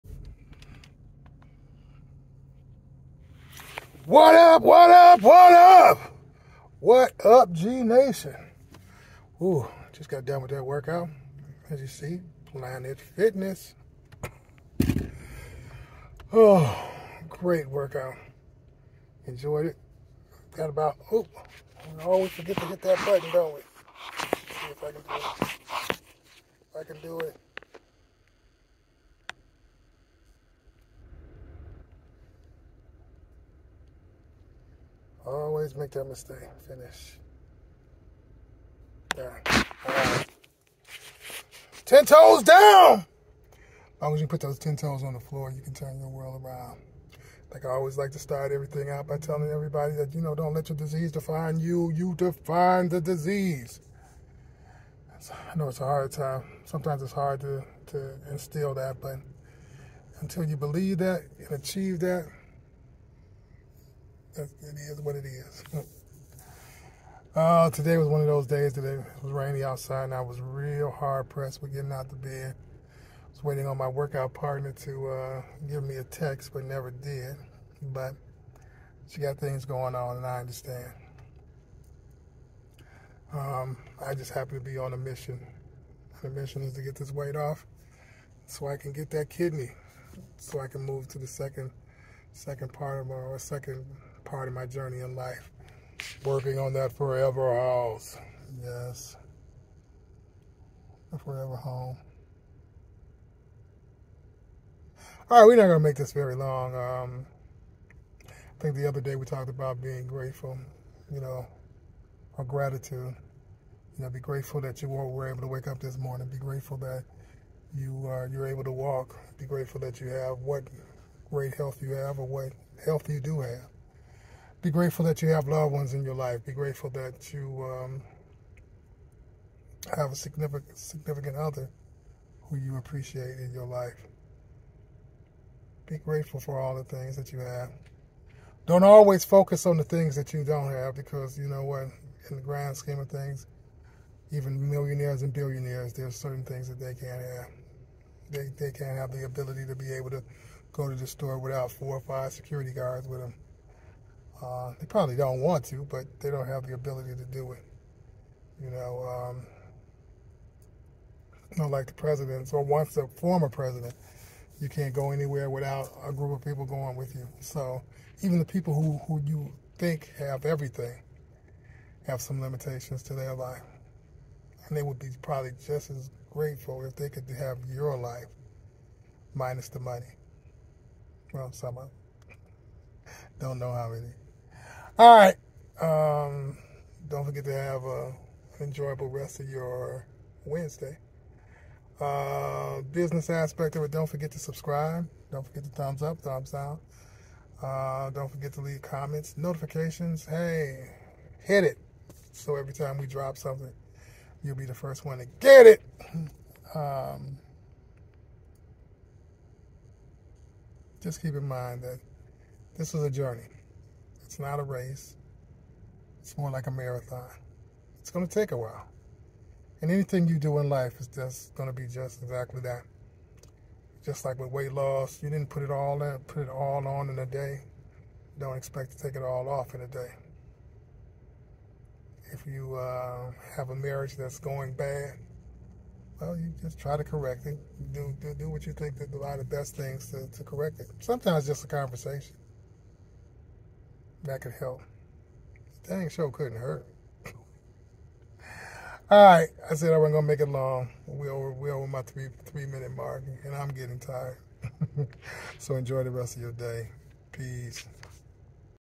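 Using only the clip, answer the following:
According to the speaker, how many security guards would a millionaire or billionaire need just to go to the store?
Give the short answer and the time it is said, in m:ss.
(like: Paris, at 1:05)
4 or 5, at 2:31.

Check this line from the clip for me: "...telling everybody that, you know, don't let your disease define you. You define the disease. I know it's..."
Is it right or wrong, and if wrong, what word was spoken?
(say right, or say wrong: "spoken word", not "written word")
right.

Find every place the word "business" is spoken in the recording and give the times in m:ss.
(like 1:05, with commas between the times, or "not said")
3:12.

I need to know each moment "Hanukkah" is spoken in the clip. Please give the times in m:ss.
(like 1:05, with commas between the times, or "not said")
not said.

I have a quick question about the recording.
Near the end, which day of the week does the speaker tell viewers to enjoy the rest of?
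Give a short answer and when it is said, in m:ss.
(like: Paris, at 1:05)
Wednesday, at 3:10.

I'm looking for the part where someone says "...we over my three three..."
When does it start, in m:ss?
4:11.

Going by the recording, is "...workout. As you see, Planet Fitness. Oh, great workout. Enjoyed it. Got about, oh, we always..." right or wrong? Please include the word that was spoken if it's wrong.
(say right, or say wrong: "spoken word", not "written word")
right.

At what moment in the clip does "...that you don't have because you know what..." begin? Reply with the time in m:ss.
2:20.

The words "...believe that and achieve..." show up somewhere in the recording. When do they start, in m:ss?
1:00.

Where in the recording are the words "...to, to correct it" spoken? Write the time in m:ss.
4:00.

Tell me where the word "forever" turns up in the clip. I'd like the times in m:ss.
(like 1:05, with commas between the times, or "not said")
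1:36, 1:41.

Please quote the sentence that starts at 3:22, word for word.
So every time we drop something, you'll be the first one to get it.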